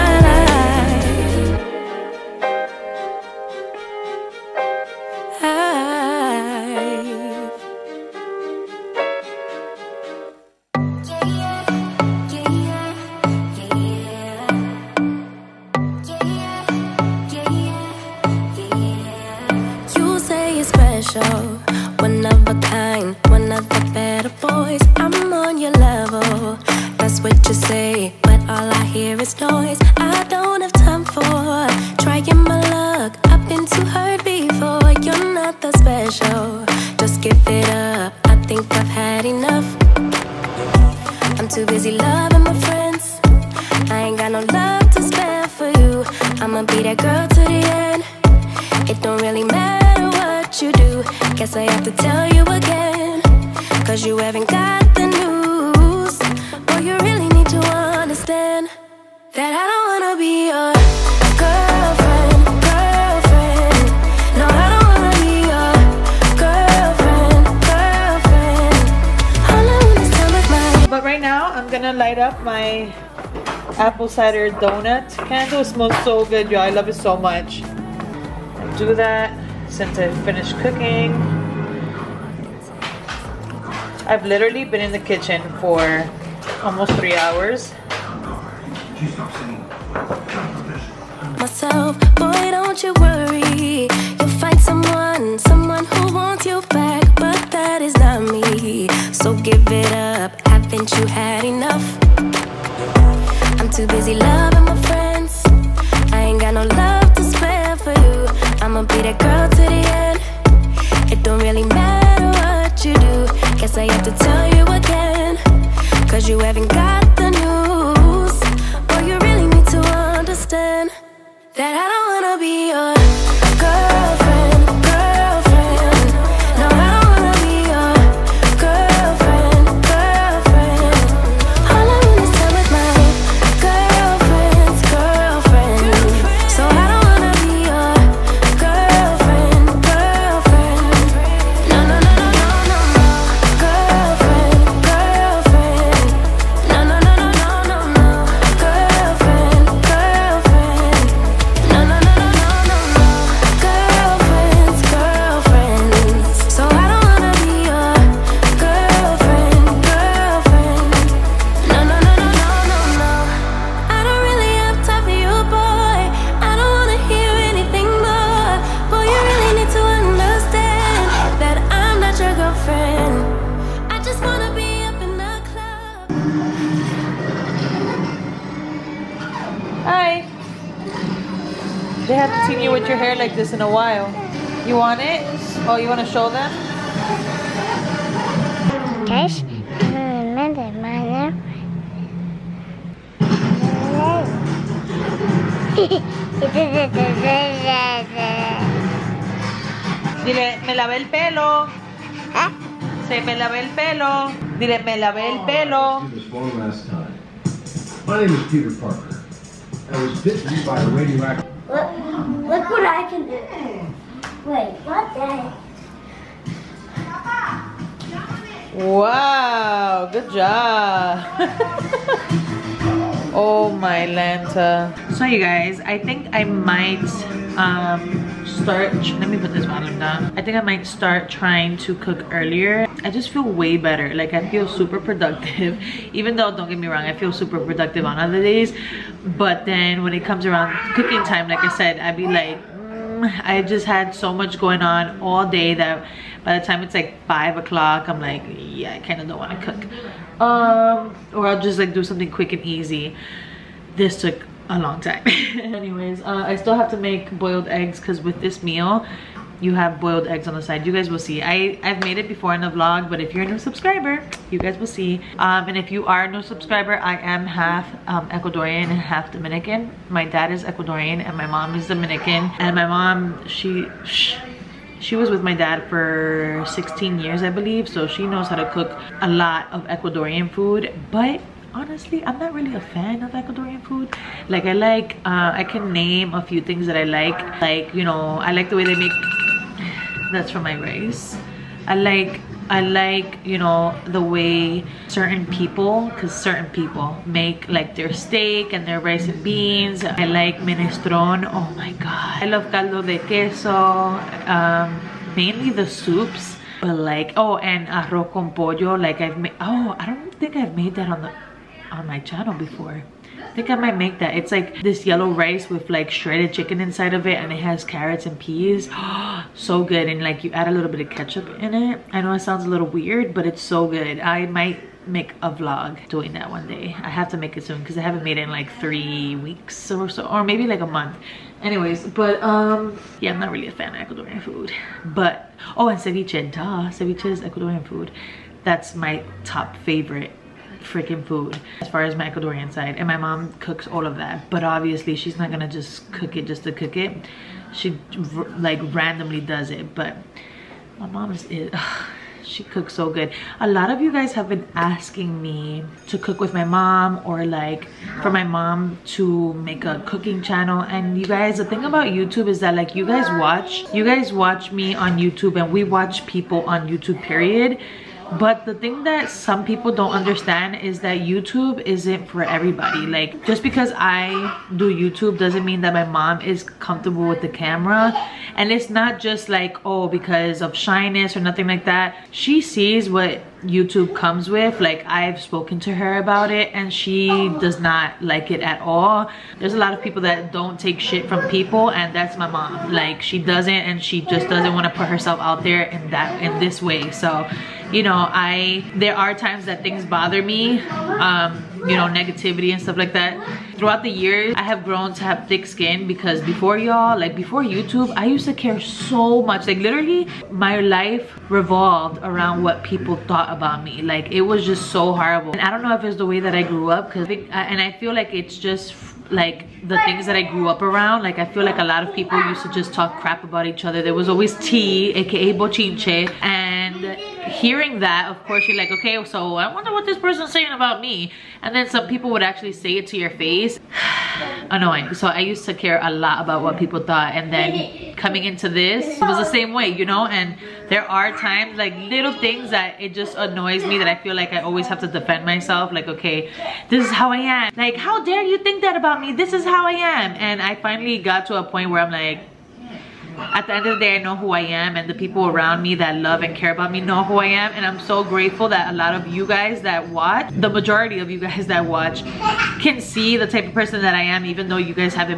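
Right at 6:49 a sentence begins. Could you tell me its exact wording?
Like literally, my life revolved around what people thought about me.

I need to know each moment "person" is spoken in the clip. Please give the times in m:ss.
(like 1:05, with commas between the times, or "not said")
7:10, 7:43.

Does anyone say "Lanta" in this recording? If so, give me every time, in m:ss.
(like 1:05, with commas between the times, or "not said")
3:44.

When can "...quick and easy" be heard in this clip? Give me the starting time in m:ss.
4:12.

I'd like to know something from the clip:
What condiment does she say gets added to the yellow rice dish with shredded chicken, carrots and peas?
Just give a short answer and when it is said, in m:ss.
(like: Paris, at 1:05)
Ketchup, at 5:21.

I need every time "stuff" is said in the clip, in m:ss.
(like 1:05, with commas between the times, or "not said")
6:42.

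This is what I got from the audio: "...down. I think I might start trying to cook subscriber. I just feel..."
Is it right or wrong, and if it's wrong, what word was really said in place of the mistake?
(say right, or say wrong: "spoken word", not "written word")
wrong: "earlier", not "subscriber".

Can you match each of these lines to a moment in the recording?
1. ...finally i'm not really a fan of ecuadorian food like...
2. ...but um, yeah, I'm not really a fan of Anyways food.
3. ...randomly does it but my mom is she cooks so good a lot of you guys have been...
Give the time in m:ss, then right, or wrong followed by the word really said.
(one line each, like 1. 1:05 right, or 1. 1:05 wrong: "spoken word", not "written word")
1. 4:41 wrong: "honestly", not "finally"
2. 5:32 wrong: "Ecuadorian", not "Anyways"
3. 5:48 right.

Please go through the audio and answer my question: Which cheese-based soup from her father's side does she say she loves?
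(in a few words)
Caldo de queso.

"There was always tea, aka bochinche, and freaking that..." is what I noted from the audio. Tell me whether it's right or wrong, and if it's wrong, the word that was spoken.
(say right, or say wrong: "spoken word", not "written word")
wrong: "hearing", not "freaking".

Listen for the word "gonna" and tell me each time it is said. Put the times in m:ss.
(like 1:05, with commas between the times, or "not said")
1:11, 5:45.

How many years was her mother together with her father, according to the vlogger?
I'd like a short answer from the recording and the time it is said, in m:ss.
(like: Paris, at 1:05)
16, at 4:36.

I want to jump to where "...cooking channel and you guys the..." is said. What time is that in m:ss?
6:00.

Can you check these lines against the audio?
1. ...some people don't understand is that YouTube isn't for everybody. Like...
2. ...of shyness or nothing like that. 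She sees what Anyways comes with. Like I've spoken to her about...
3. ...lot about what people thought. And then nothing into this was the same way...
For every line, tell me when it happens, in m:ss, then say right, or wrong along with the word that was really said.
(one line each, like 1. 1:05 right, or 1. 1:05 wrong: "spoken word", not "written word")
1. 6:09 right
2. 6:20 wrong: "YouTube", not "Anyways"
3. 7:16 wrong: "coming", not "nothing".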